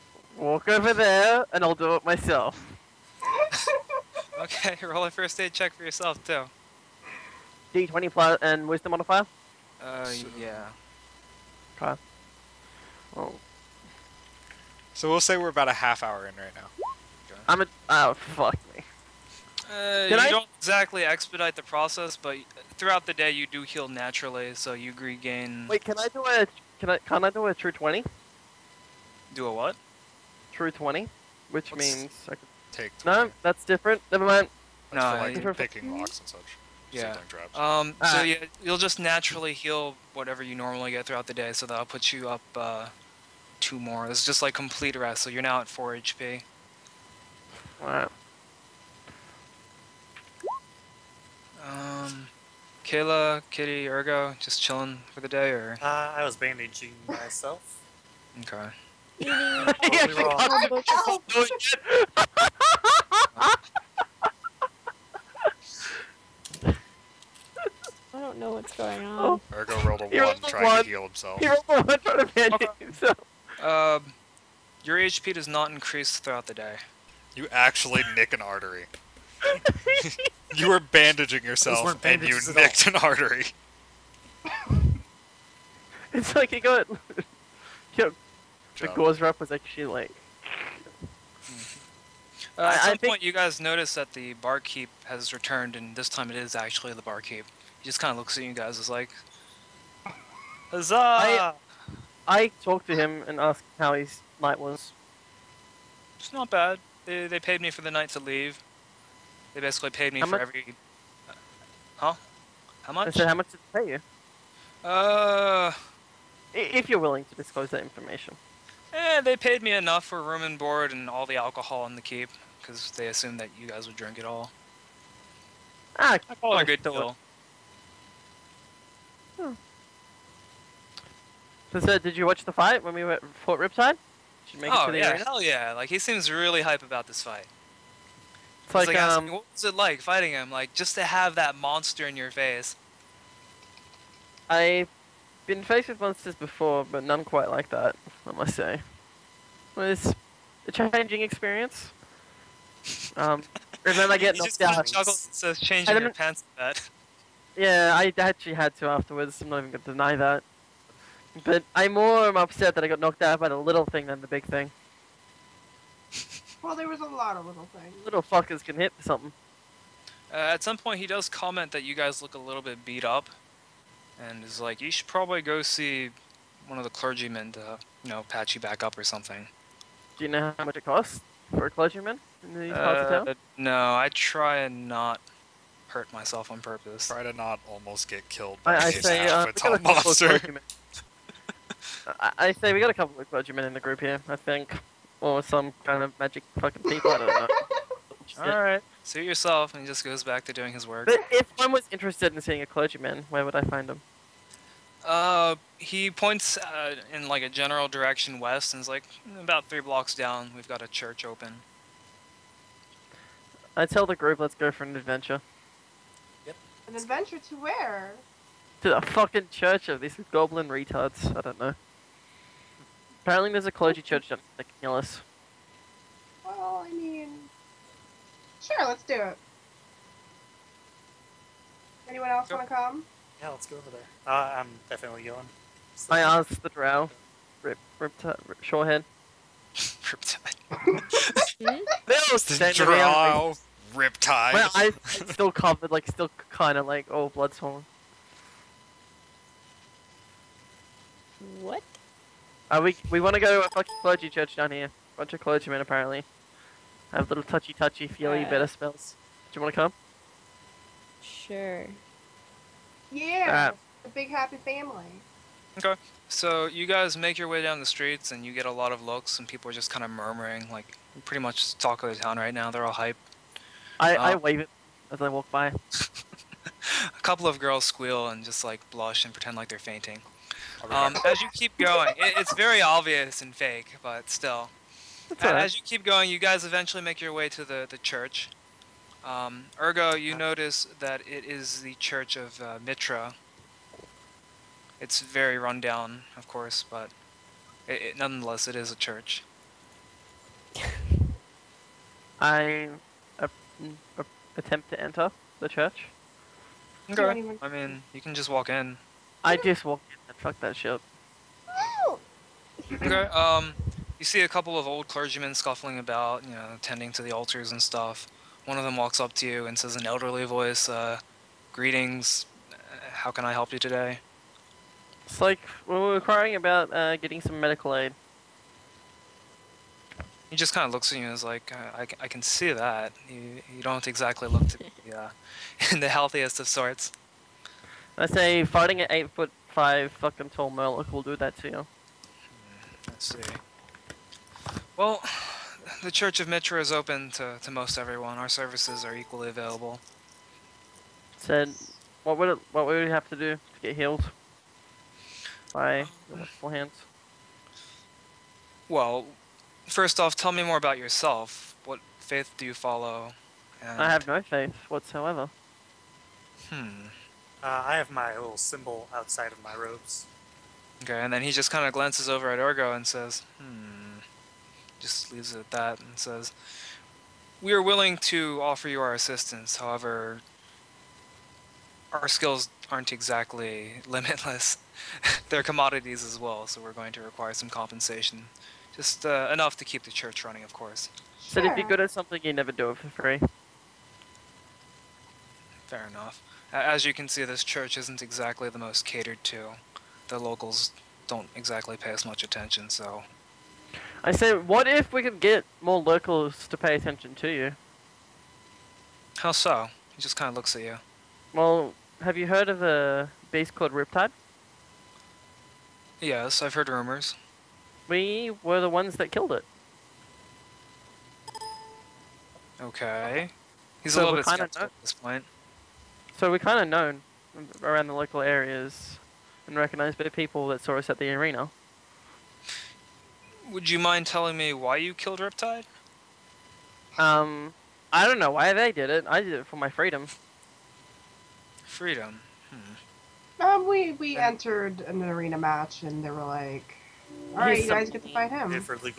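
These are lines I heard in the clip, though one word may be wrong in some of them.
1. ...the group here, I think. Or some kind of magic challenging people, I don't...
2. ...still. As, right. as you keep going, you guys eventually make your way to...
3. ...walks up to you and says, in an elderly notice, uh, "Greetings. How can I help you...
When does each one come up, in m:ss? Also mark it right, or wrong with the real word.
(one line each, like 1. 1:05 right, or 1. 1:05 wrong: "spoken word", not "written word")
1. 3:13 wrong: "fucking", not "challenging"
2. 4:44 right
3. 5:18 wrong: "voice", not "notice".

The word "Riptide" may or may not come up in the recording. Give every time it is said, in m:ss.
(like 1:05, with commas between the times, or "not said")
2:13, 3:59, 4:03, 6:53, 7:15.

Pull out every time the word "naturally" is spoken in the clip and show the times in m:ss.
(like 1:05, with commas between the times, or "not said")
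0:23, 0:38.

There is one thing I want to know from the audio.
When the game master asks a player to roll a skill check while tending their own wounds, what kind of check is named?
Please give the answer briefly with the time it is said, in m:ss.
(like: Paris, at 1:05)
First aid, at 0:05.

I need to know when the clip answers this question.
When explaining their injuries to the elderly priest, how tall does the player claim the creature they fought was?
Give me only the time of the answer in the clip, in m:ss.
5:39.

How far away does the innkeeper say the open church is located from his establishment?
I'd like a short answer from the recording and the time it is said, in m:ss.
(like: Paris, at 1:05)
Three blocks, at 3:29.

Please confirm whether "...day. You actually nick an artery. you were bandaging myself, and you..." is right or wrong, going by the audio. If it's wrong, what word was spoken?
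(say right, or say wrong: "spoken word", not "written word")
wrong: "yourself", not "myself".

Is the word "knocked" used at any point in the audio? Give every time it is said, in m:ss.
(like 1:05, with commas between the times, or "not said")
2:34, 2:42.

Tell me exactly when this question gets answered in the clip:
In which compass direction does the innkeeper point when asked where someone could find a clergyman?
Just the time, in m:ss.
3:28.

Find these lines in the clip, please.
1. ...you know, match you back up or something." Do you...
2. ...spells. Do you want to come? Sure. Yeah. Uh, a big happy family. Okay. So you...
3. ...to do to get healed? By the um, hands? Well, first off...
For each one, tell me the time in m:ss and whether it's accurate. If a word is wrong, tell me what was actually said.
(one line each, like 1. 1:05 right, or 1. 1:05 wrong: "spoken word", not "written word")
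1. 2:58 wrong: "patch", not "match"
2. 4:18 right
3. 5:53 right.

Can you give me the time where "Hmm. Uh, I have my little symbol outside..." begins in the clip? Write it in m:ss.
6:06.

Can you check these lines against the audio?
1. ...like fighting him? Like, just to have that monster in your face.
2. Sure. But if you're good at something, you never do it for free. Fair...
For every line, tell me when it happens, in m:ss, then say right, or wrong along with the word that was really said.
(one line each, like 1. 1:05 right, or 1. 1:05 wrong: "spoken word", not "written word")
1. 2:19 right
2. 6:31 right.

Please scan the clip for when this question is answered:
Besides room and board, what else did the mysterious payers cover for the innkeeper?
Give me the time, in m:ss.
2:01.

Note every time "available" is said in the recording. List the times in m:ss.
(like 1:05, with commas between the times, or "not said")
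5:49.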